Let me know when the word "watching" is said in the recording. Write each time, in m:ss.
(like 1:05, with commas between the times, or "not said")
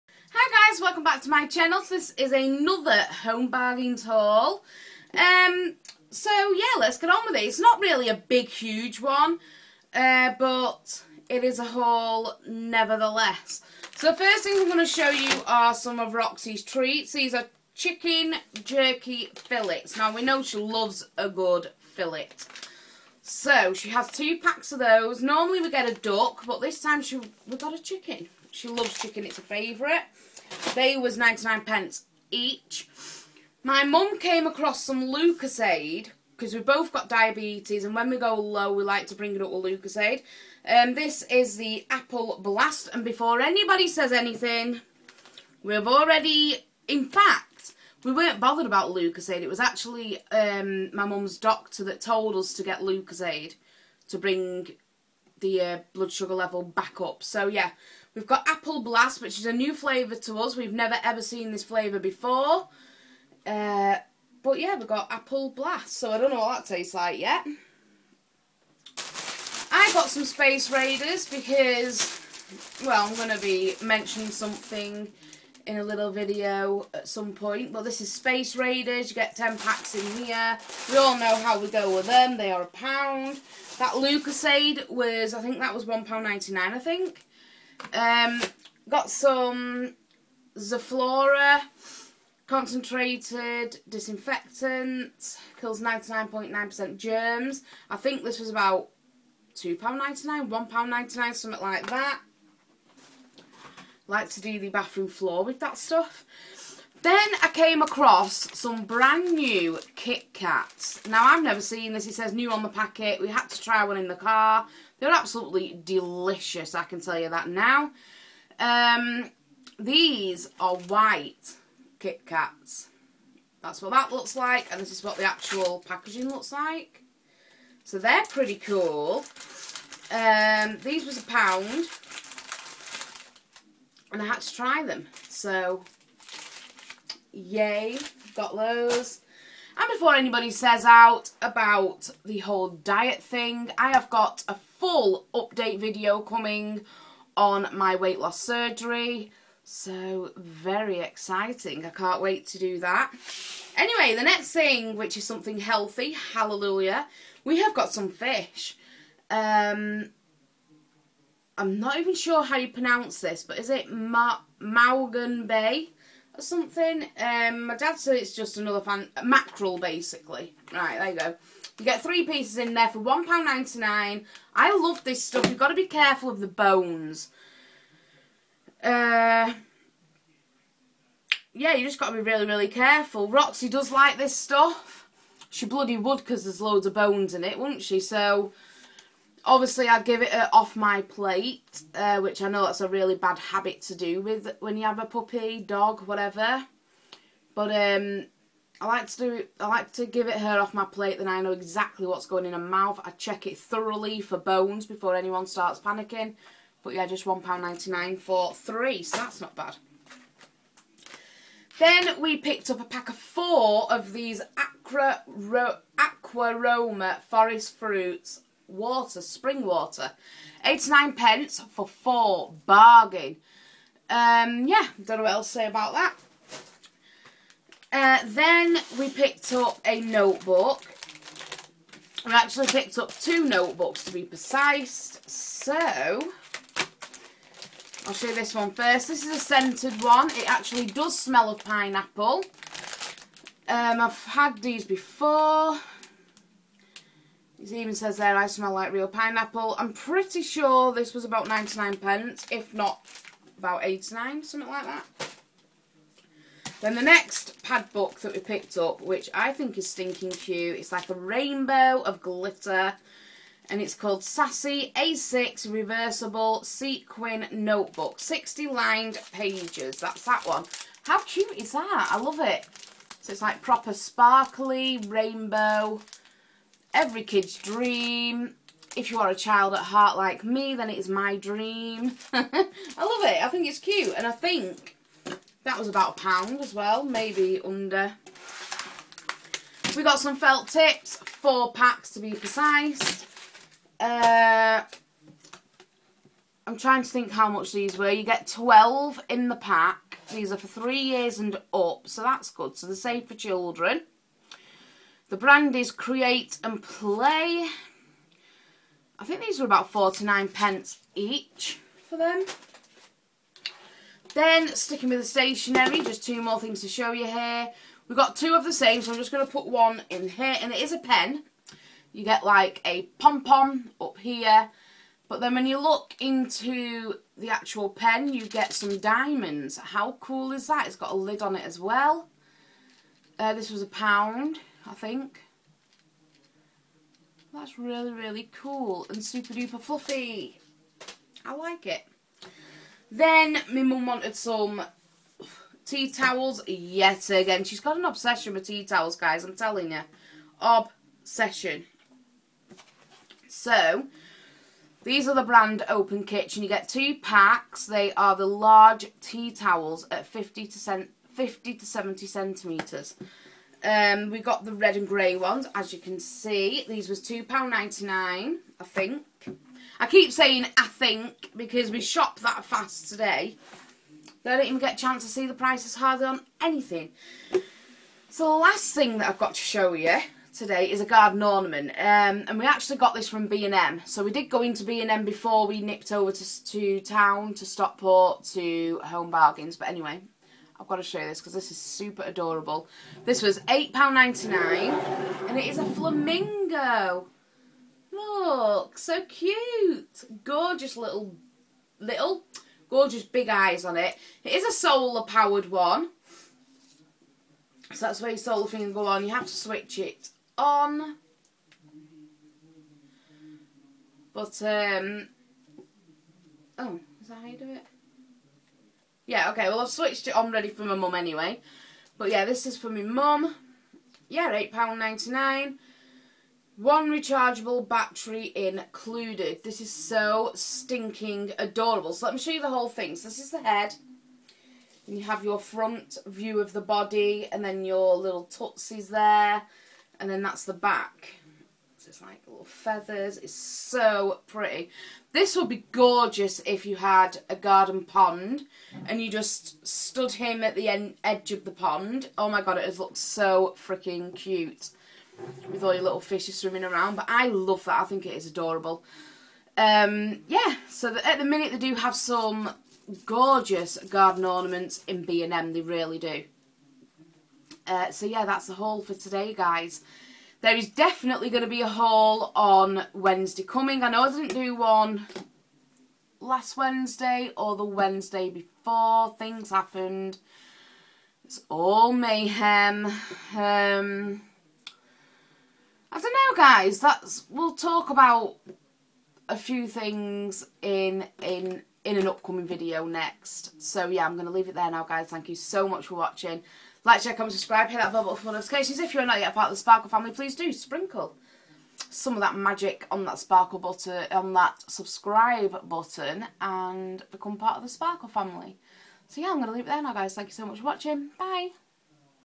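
8:16, 8:30.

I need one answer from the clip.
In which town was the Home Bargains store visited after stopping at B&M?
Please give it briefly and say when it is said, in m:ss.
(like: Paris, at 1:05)
Stockport, at 6:27.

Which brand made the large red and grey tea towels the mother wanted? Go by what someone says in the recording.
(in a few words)
Open Kitchen.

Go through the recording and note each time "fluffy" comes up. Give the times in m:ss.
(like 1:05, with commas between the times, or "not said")
5:39.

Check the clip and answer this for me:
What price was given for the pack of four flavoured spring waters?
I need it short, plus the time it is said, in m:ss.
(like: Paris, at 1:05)
89p, at 3:40.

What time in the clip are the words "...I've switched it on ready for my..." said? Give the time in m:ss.
6:59.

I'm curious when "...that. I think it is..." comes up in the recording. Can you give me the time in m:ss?
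7:37.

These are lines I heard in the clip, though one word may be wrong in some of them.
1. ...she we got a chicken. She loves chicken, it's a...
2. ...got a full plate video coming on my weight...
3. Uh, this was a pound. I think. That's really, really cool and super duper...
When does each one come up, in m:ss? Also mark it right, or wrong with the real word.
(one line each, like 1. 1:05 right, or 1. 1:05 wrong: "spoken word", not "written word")
1. 0:27 right
2. 2:24 wrong: "update", not "plate"
3. 5:33 right.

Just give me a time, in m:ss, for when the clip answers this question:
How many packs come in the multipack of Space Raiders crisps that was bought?
1:19.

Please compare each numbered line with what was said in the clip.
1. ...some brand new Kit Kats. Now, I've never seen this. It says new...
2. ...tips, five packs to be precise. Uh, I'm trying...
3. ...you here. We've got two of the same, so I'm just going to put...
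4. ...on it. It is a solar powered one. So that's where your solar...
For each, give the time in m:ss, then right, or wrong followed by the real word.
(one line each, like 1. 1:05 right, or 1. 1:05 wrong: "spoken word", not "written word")
1. 1:48 right
2. 4:50 wrong: "four", not "five"
3. 5:17 right
4. 6:43 right.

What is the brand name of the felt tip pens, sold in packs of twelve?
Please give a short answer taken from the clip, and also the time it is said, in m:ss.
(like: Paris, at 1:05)
Create and Play, at 5:05.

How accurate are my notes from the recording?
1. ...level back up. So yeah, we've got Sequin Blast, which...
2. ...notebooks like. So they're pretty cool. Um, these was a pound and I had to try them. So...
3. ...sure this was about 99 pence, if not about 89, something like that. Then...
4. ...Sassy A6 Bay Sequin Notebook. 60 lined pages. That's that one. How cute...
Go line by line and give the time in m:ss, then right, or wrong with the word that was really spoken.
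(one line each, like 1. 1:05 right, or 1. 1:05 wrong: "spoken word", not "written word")
1. 0:56 wrong: "Apple", not "Sequin"
2. 2:06 wrong: "looks", not "notebooks"
3. 4:10 right
4. 4:24 wrong: "Reversible", not "Bay".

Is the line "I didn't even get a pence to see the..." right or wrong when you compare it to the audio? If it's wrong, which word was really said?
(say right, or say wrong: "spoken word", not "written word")
wrong: "chance", not "pence".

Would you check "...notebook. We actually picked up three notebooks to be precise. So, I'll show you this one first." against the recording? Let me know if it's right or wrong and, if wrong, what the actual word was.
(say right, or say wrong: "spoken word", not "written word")
wrong: "two", not "three".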